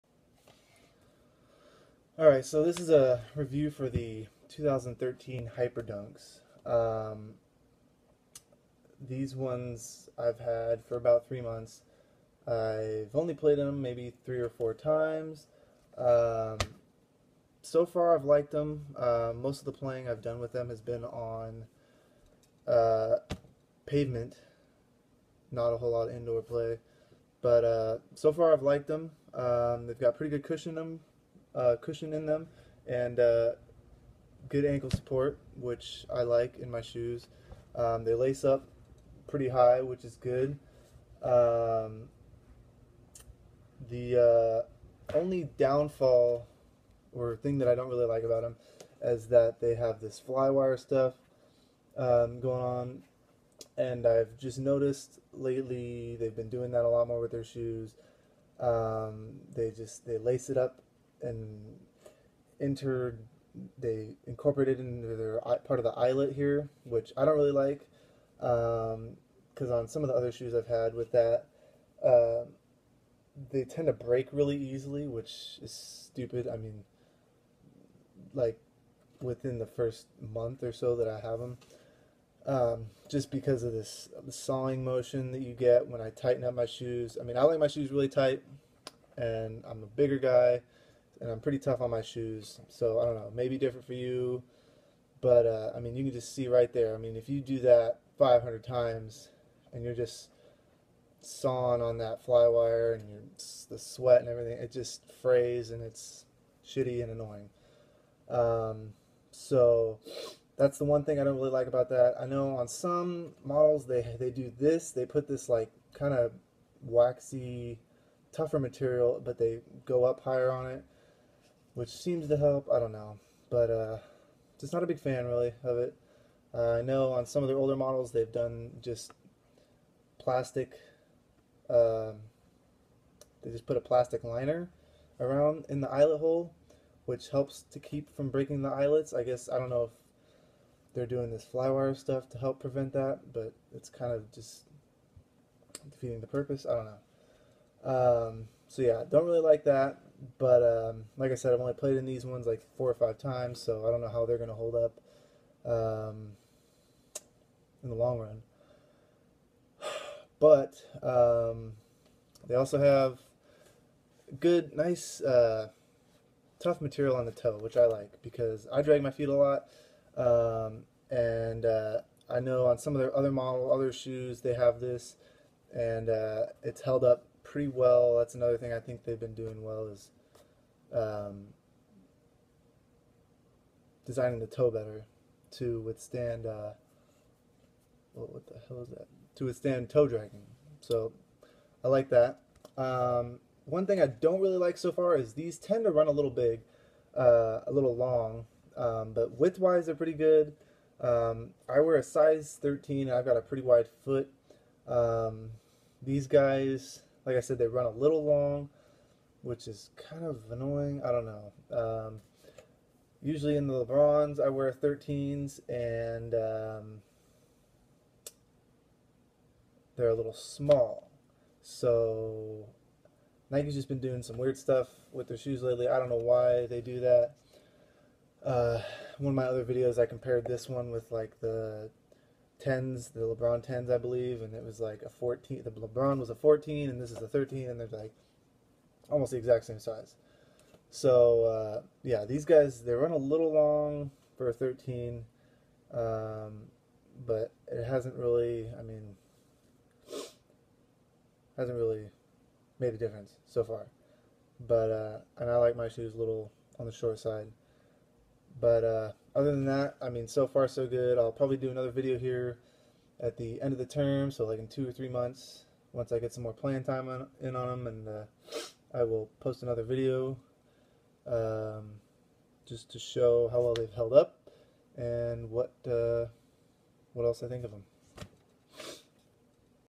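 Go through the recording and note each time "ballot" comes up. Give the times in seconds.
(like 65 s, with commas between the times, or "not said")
not said.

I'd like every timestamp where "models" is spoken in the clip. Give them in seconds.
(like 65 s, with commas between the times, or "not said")
113 s, 127 s, 173 s.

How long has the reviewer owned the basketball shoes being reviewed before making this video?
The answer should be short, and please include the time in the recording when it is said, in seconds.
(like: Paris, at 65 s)
3 months, at 10 s.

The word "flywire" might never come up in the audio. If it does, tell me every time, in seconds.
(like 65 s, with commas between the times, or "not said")
50 s, 141 s.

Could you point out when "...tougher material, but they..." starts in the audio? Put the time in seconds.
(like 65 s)
118 s.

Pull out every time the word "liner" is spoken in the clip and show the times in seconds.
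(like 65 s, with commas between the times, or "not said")
134 s.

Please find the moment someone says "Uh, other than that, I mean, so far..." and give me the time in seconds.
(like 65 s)
258 s.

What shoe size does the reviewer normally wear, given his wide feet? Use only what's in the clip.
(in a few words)
13.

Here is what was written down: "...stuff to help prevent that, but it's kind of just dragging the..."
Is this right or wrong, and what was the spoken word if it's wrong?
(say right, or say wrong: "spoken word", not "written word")
wrong: "defeating", not "dragging".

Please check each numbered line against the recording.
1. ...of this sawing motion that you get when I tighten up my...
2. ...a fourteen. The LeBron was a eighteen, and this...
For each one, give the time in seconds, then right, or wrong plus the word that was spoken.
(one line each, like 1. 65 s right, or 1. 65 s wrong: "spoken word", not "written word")
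1. 83 s right
2. 235 s wrong: "fourteen", not "eighteen".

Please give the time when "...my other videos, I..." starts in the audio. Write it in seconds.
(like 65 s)
229 s.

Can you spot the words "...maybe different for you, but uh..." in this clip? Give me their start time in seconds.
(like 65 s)
93 s.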